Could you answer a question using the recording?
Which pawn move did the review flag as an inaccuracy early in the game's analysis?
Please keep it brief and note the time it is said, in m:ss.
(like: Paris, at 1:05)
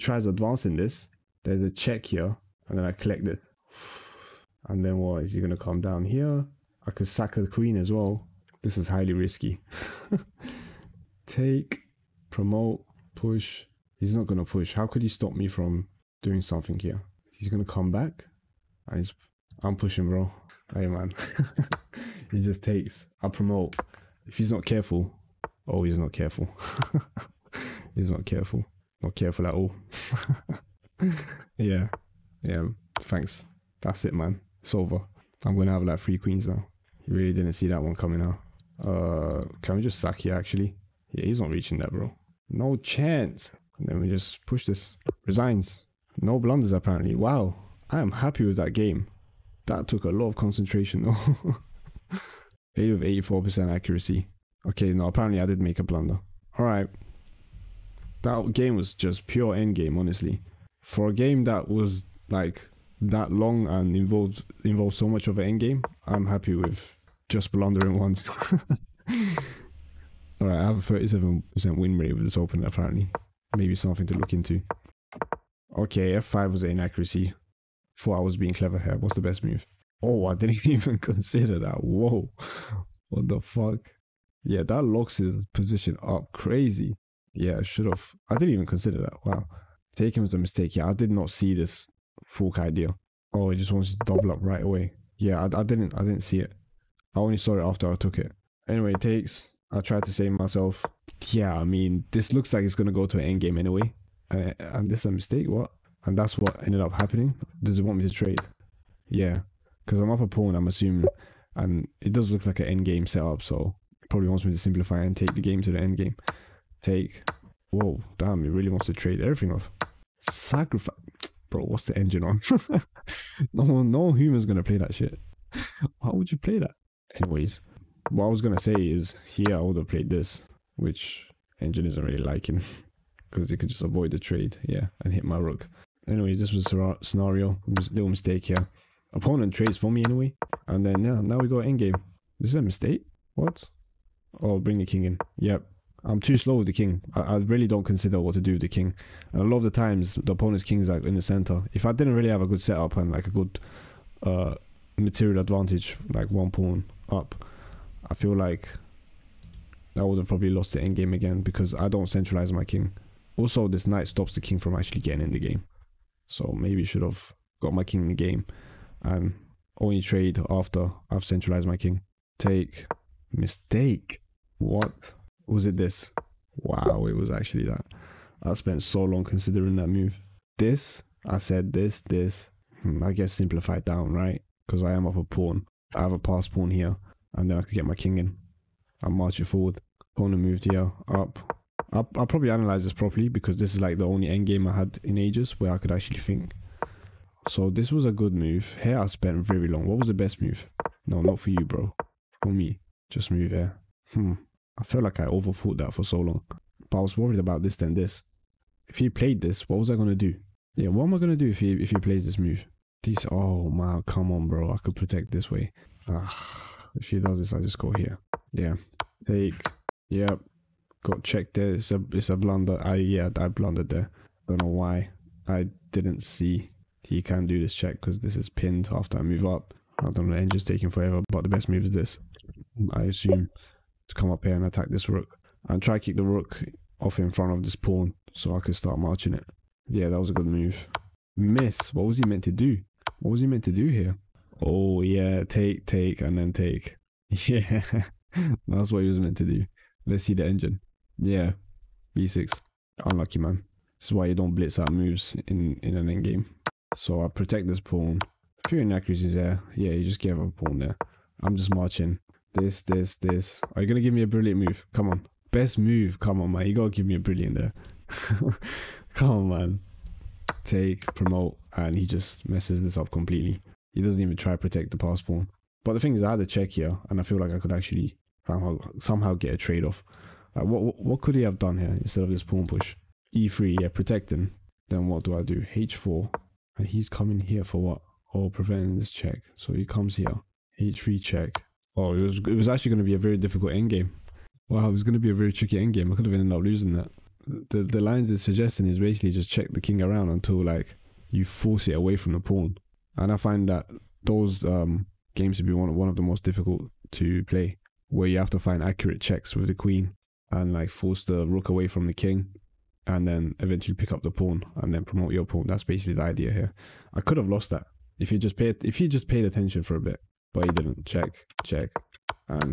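F5, at 1:16.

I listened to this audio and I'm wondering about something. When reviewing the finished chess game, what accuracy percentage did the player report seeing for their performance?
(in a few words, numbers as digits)
84%.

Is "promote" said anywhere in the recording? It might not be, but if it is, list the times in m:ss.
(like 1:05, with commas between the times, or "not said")
0:12, 0:23, 4:31, 5:15.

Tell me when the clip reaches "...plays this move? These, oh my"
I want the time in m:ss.
3:31.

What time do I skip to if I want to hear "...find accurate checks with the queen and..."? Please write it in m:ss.
5:08.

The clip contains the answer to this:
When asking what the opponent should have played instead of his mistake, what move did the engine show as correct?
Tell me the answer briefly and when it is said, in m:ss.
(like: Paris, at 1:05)
B6, at 4:12.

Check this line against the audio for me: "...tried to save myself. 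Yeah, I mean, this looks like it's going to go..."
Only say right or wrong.
right.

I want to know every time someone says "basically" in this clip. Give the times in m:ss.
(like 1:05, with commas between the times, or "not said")
4:58, 5:15.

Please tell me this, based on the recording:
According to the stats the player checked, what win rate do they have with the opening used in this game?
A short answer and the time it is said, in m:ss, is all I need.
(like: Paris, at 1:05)
37%, at 1:10.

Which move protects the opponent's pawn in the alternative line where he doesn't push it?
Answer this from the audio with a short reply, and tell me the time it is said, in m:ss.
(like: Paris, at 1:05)
E3, at 4:43.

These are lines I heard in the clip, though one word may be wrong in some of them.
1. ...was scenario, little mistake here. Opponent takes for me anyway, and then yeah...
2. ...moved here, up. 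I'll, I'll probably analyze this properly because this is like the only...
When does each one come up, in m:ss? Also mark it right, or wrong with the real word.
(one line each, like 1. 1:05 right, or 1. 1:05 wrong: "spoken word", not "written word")
1. 2:16 wrong: "trades", not "takes"
2. 3:10 right.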